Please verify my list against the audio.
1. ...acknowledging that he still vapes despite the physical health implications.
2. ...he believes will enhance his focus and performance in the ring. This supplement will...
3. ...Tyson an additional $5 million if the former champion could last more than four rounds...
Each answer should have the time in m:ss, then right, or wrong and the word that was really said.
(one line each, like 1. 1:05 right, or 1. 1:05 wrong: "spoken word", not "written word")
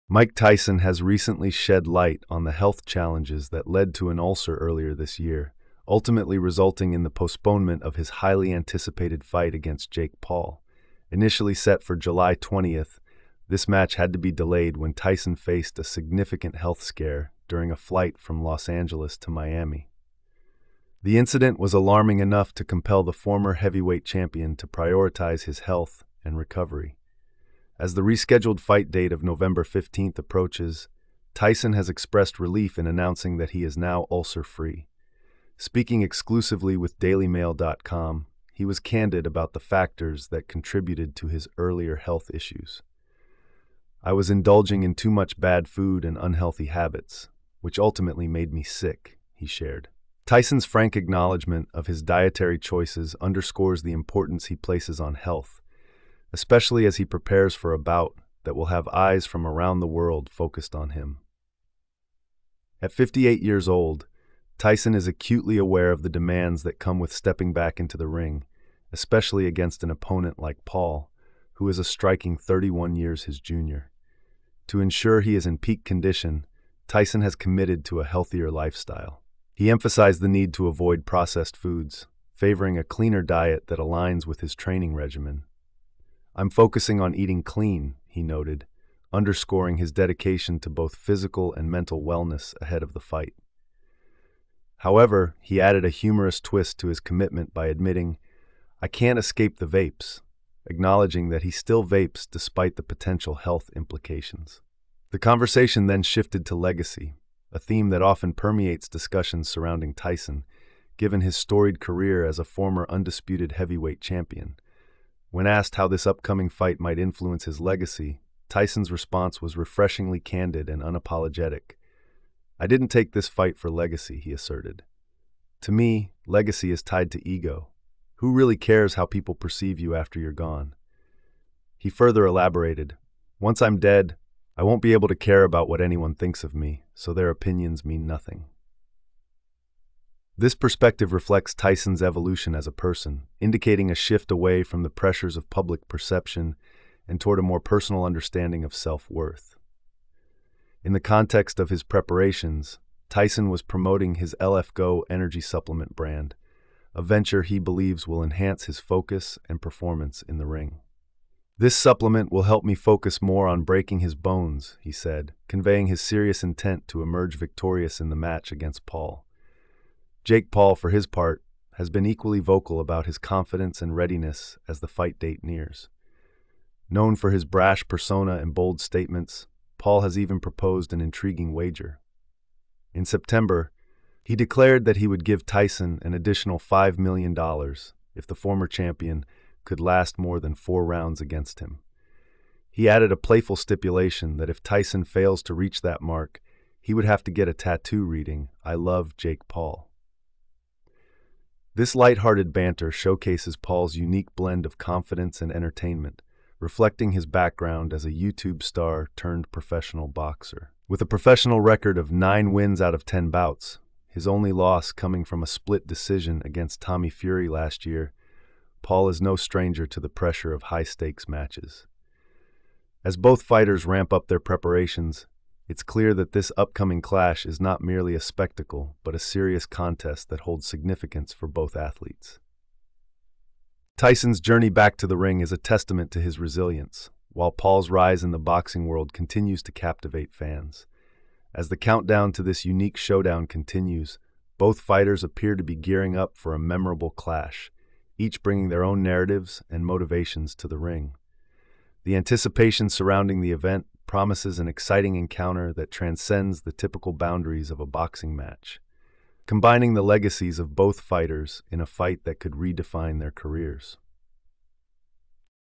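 1. 1:40 wrong: "potential", not "physical"
2. 2:37 right
3. 3:05 right.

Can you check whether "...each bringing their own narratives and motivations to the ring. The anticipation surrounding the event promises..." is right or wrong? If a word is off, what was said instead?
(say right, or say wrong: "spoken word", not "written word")
right.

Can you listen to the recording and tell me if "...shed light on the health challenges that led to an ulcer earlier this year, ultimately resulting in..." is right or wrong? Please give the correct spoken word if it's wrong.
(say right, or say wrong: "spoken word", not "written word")
right.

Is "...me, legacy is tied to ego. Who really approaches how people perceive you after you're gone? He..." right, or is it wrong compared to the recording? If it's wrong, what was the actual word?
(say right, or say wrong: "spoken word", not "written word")
wrong: "cares", not "approaches".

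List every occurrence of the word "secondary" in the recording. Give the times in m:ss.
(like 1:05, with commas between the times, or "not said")
not said.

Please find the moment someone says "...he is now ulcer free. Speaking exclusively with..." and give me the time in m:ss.
0:33.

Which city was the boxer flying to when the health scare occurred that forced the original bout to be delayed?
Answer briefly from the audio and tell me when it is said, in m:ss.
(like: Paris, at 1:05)
Miami, at 0:19.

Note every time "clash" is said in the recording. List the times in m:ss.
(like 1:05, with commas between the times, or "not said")
3:47, 4:07.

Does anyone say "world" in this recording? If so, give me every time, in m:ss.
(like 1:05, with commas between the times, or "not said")
0:59, 3:58.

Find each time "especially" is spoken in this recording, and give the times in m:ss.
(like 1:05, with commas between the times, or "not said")
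0:56, 1:08.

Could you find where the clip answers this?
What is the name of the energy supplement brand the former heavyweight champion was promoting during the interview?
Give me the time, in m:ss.
2:34.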